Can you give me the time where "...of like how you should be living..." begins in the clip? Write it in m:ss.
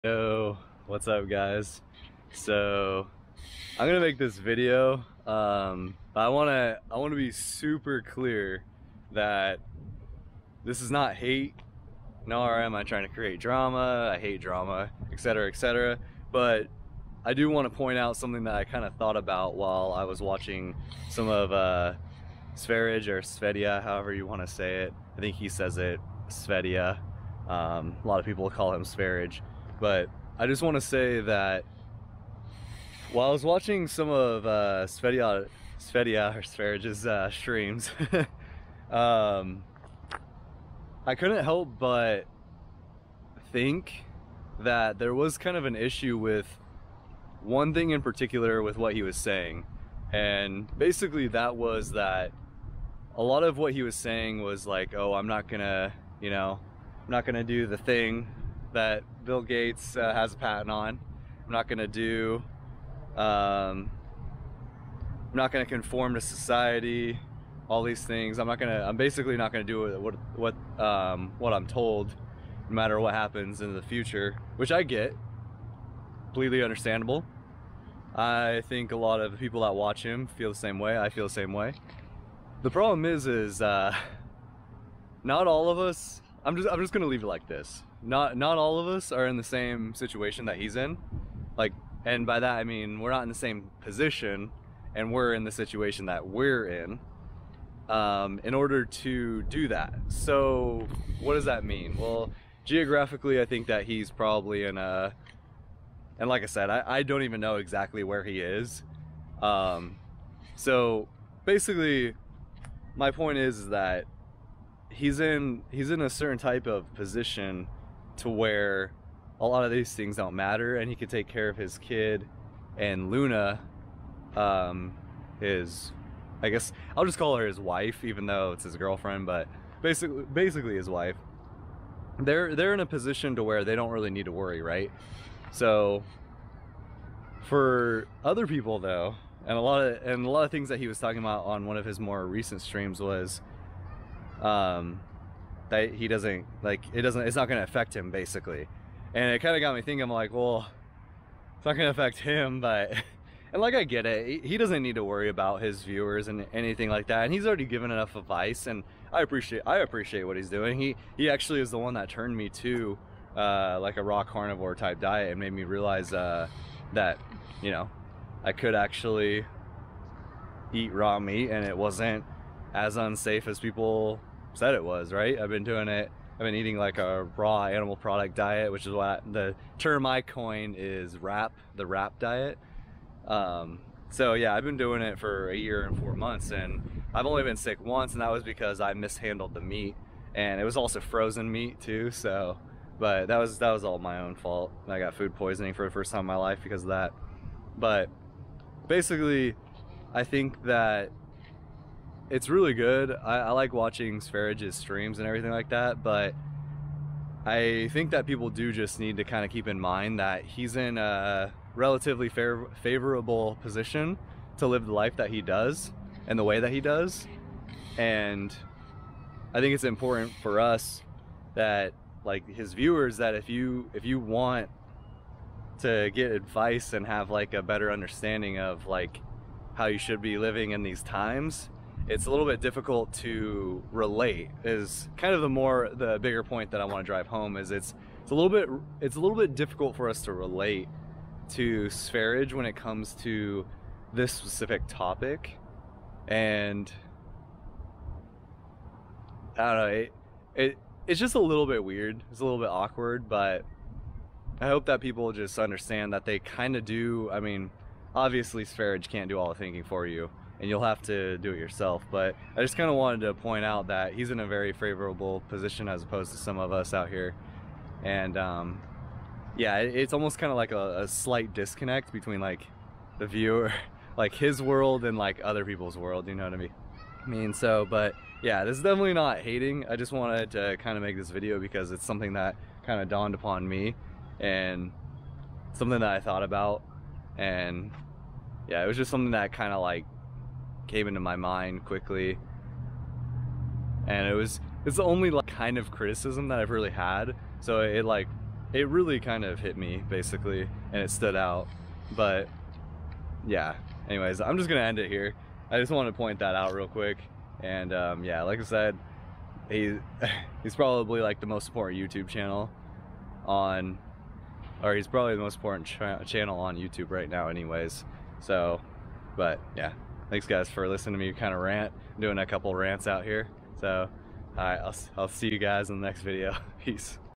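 3:48.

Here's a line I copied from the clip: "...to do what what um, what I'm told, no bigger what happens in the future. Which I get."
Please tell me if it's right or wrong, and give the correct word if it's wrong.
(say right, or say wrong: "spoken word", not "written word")
wrong: "matter", not "bigger".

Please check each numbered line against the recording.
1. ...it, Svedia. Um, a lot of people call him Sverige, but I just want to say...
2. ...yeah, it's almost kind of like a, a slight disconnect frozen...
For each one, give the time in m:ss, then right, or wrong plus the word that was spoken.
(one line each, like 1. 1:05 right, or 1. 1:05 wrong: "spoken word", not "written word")
1. 0:25 right
2. 4:29 wrong: "between", not "frozen".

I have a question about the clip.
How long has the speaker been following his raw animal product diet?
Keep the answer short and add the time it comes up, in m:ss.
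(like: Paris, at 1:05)
a year and four months, at 3:05.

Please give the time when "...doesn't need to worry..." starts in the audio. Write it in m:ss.
2:34.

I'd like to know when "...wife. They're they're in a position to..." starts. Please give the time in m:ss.
2:10.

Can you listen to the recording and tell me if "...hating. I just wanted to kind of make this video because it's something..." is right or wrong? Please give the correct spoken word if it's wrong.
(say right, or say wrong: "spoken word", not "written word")
right.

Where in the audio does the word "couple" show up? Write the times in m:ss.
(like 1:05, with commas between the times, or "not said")
5:22.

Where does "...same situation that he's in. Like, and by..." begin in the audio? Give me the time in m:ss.
1:29.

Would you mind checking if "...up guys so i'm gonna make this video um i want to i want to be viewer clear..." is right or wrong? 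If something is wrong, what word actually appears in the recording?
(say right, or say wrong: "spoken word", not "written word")
wrong: "super", not "viewer".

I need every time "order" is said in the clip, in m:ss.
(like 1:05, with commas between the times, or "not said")
1:38.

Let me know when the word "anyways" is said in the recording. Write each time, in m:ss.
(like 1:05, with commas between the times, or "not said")
5:04, 5:17.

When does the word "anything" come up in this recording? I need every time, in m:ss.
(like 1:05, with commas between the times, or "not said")
2:36.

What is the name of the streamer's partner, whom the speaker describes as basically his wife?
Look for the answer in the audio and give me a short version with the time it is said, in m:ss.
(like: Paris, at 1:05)
Luna, at 2:03.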